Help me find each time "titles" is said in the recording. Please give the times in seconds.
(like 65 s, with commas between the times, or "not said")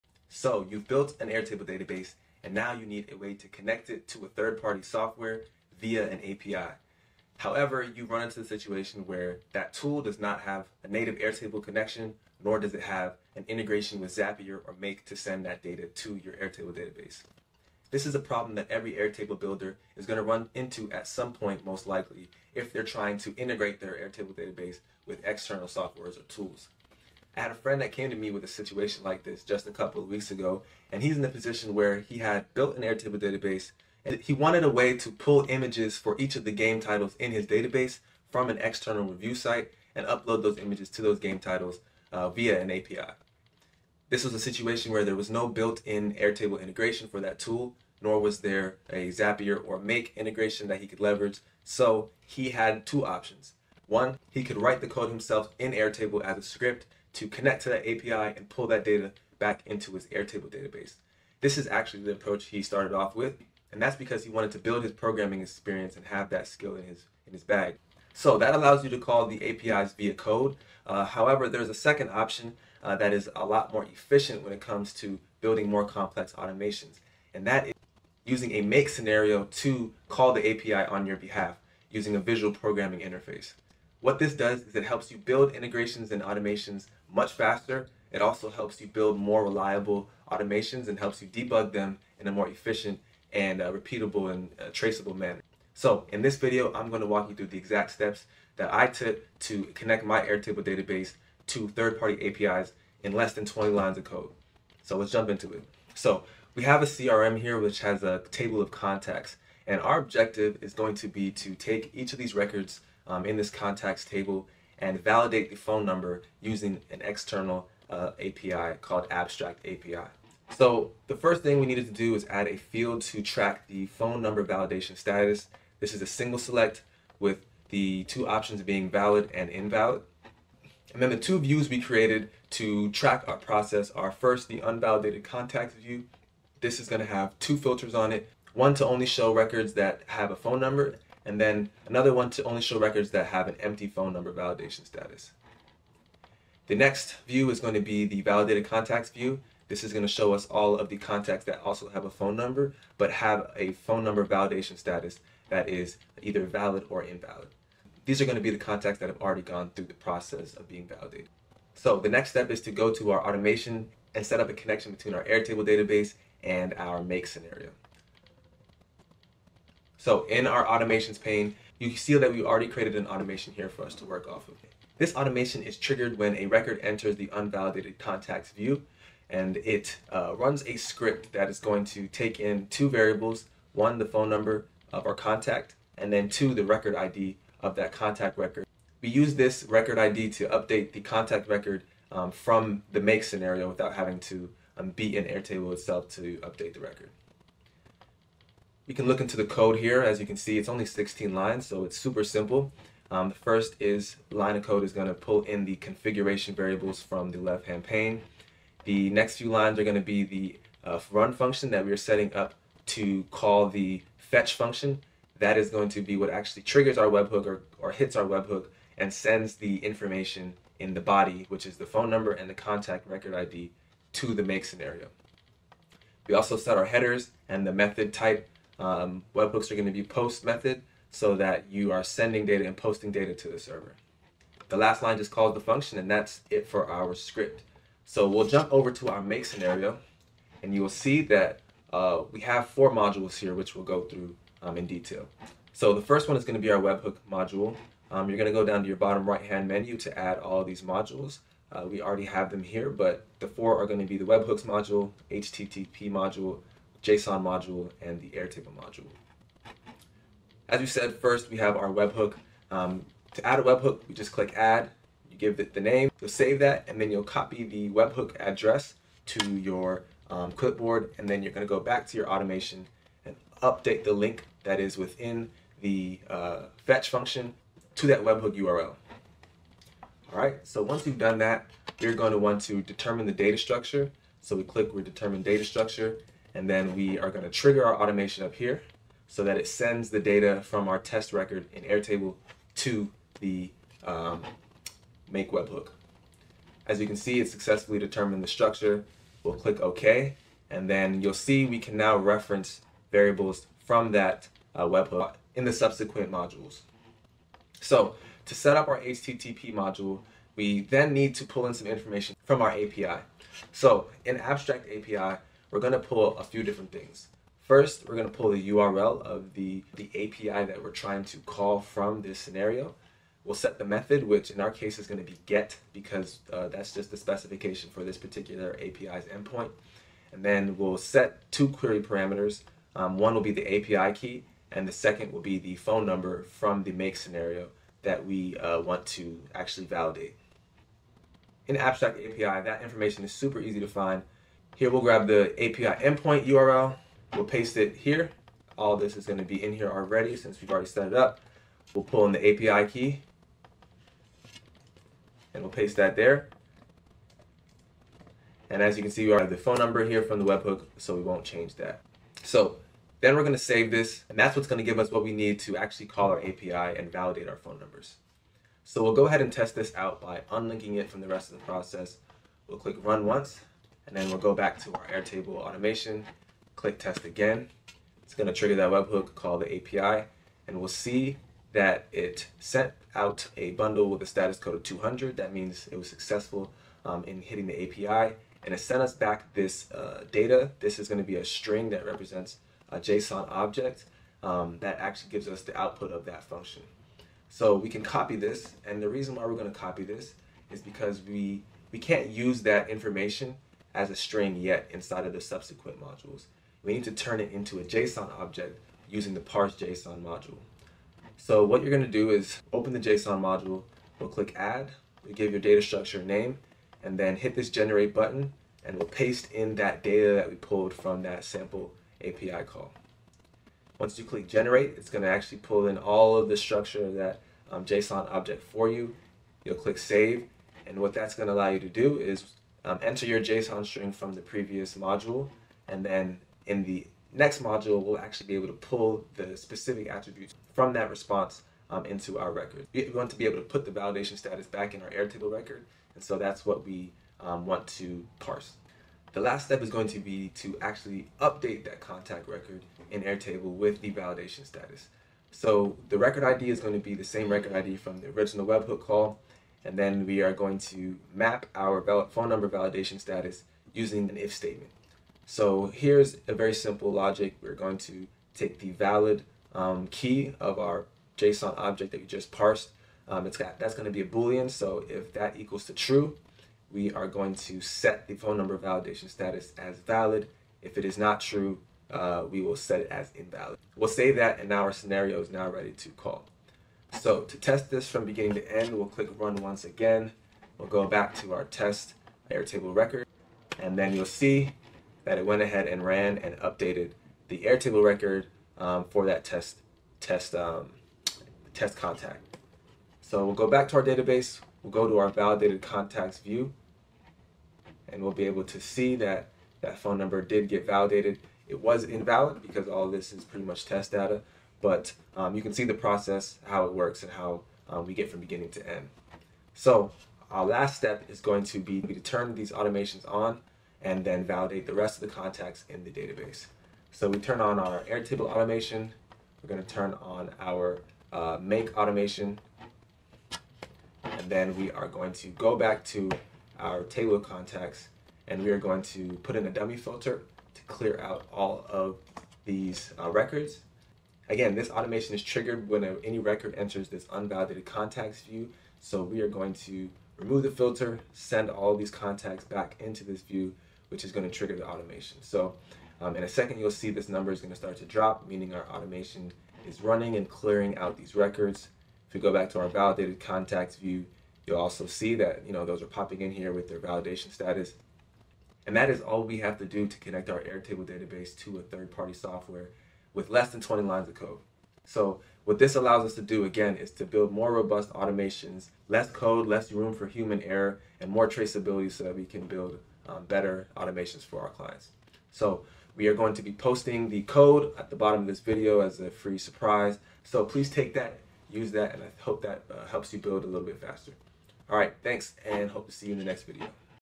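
36 s, 41 s.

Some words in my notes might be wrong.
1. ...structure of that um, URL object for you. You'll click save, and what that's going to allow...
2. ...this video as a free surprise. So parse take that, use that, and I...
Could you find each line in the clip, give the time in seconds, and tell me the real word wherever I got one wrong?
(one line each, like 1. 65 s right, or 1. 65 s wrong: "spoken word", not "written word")
1. 426 s wrong: "JSON", not "URL"
2. 588 s wrong: "please", not "parse".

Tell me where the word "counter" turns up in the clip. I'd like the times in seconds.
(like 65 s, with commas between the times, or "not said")
not said.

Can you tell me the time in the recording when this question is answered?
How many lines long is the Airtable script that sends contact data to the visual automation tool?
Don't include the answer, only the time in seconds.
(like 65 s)
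200 s.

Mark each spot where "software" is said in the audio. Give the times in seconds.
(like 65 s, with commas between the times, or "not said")
4 s, 25 s, 572 s.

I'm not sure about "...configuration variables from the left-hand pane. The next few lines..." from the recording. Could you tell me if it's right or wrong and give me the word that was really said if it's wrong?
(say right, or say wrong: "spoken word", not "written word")
right.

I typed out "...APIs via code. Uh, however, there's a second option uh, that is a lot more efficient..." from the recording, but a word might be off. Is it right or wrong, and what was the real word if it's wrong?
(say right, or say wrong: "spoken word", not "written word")
right.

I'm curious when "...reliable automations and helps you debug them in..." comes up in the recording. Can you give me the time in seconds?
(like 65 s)
89 s.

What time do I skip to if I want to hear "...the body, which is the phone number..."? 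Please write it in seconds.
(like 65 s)
220 s.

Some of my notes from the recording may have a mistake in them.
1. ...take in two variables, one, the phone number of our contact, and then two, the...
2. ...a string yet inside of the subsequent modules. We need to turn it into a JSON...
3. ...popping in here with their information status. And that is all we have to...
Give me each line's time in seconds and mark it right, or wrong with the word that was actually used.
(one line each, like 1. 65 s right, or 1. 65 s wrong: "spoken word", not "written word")
1. 182 s right
2. 404 s right
3. 566 s wrong: "validation", not "information".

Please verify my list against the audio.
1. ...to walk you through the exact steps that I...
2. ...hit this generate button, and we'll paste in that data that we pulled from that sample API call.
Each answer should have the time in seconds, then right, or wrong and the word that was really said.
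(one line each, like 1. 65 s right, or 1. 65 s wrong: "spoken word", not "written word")
1. 97 s right
2. 417 s right.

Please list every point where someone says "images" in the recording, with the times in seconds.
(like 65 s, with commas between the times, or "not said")
35 s, 40 s.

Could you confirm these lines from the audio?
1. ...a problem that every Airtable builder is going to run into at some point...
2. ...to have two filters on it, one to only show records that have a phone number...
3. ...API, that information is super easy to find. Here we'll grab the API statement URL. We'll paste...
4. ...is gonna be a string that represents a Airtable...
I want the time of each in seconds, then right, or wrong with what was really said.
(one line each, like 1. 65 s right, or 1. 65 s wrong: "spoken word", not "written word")
1. 18 s right
2. 136 s right
3. 342 s wrong: "endpoint", not "statement"
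4. 390 s wrong: "JSON", not "Airtable".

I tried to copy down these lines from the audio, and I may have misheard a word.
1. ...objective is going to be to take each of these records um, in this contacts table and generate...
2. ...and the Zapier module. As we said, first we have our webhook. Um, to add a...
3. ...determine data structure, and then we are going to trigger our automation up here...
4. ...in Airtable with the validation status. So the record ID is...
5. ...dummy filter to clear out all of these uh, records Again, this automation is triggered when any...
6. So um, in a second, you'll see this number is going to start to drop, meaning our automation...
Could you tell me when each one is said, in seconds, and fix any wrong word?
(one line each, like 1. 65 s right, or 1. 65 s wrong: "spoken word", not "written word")
1. 109 s wrong: "validate", not "generate"
2. 258 s wrong: "Airtable", not "Zapier"
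3. 285 s right
4. 453 s right
5. 539 s right
6. 555 s right.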